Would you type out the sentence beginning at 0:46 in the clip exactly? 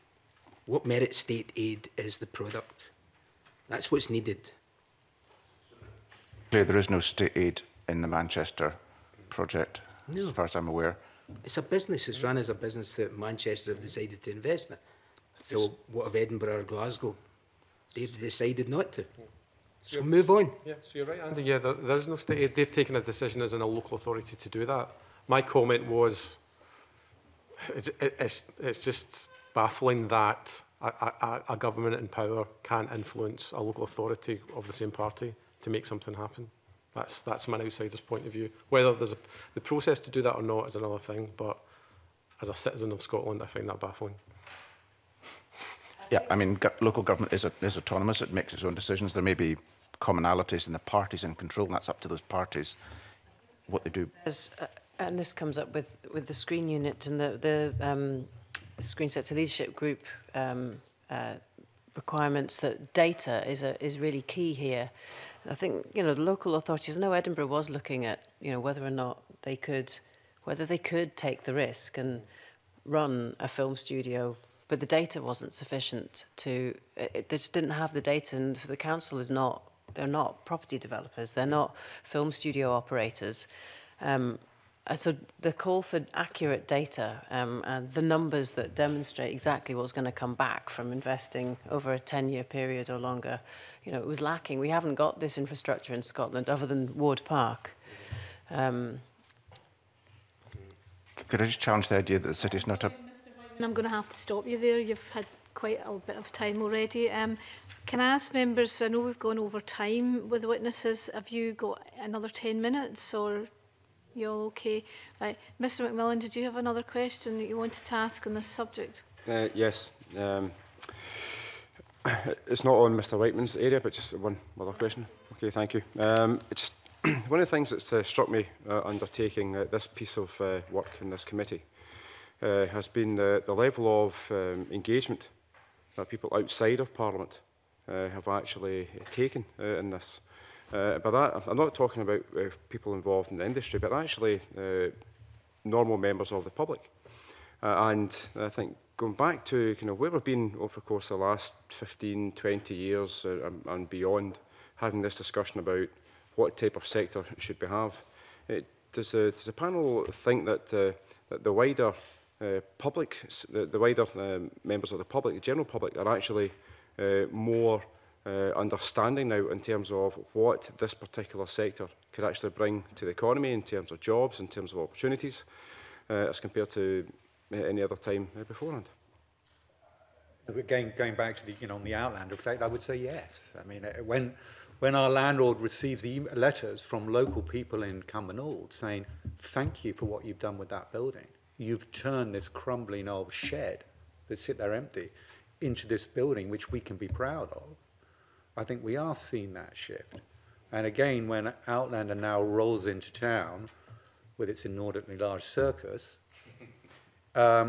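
Yeah, I mean, local government is, is autonomous.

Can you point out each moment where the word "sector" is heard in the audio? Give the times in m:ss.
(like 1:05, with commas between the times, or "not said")
0:59, 2:36, 2:51.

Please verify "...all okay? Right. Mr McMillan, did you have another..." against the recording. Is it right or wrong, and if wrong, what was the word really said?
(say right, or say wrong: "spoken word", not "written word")
right.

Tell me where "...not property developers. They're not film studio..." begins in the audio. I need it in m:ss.
1:20.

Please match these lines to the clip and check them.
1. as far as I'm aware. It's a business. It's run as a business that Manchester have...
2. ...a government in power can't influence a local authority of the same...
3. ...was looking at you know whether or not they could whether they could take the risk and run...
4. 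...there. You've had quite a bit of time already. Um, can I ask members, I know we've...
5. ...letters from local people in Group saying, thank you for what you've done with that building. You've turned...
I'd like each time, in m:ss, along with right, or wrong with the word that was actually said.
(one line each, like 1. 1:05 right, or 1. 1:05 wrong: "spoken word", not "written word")
1. 0:10 right
2. 0:31 right
3. 1:07 right
4. 1:44 right
5. 3:06 wrong: "Cumbernauld", not "Group".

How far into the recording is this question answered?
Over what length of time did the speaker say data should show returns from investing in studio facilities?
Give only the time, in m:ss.
1:31.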